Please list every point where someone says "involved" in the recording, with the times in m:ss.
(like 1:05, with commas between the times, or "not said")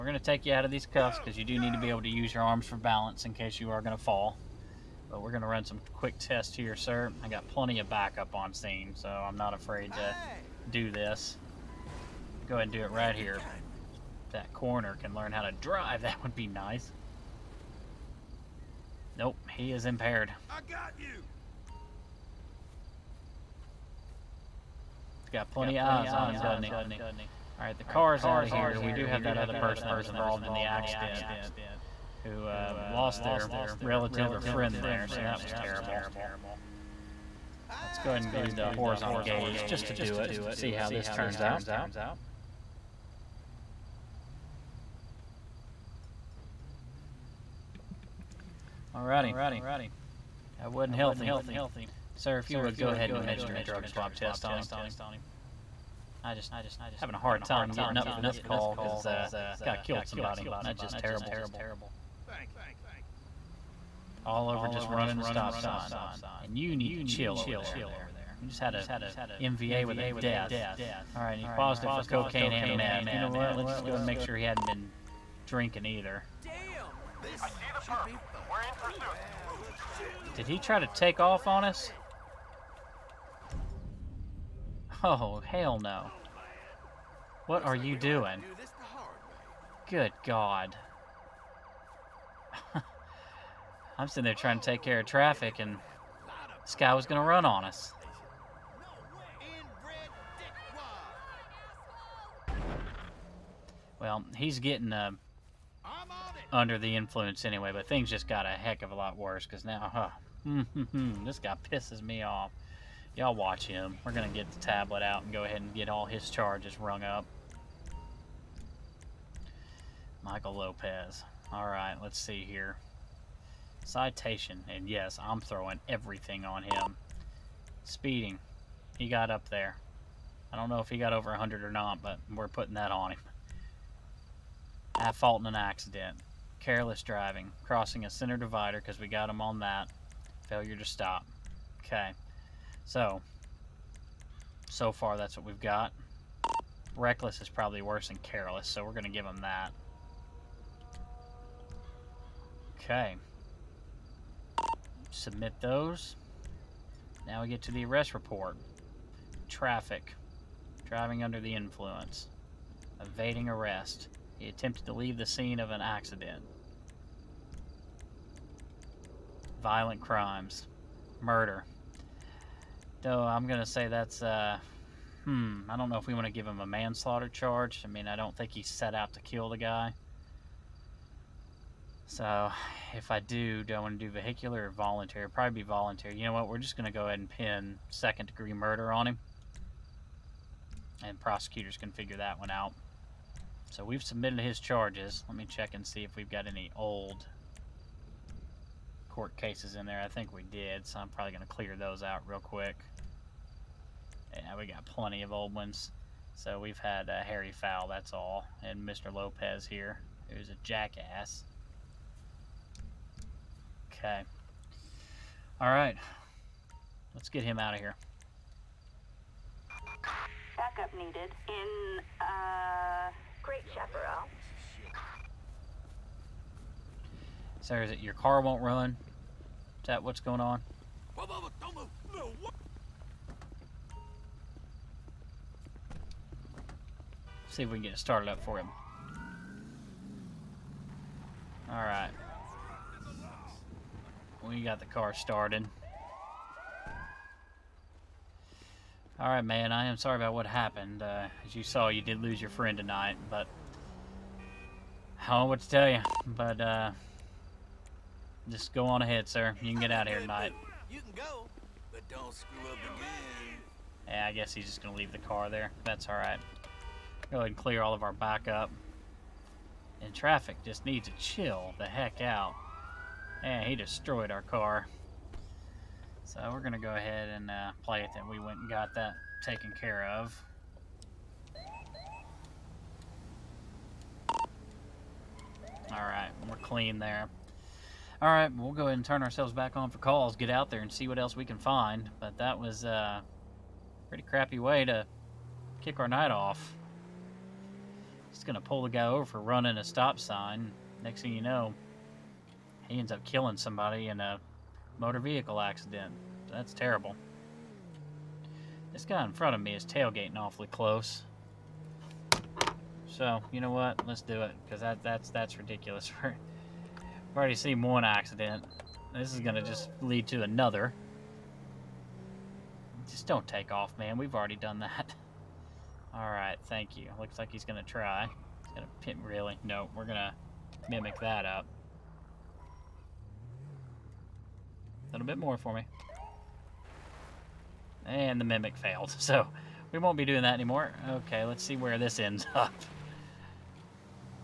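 0:30.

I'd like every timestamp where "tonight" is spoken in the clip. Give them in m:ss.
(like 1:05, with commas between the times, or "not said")
4:12, 4:20.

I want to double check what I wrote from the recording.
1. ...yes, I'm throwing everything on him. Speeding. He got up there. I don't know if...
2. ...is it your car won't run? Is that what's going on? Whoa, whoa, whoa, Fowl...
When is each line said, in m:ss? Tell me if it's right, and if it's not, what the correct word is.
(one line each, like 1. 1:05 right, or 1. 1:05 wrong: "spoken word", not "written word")
1. 2:04 right
2. 3:47 wrong: "See", not "Fowl".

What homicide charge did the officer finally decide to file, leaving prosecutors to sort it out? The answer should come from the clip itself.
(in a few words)
second degree murder.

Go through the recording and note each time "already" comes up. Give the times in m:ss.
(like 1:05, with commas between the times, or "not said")
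5:17, 5:24.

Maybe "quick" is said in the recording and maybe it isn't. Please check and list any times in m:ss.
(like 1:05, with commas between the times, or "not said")
0:05, 3:22.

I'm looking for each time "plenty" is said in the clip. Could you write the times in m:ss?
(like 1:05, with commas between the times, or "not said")
0:07, 0:25, 3:24.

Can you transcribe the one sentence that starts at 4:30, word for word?
And traffic just needs to chill the heck out.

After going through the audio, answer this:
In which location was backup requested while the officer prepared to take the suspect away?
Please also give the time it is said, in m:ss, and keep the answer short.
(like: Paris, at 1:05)
Great Chaparral, at 3:43.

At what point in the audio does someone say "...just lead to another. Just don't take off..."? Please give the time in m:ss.
5:19.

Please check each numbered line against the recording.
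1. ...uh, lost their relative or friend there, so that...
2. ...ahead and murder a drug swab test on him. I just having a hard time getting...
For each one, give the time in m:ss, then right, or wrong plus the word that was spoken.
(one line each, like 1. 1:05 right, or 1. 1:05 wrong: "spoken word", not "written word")
1. 0:32 right
2. 0:52 wrong: "administer", not "murder".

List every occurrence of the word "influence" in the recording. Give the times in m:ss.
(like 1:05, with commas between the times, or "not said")
1:46, 2:41.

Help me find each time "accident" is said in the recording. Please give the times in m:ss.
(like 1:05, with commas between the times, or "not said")
0:30, 2:15, 2:45, 5:05, 5:18.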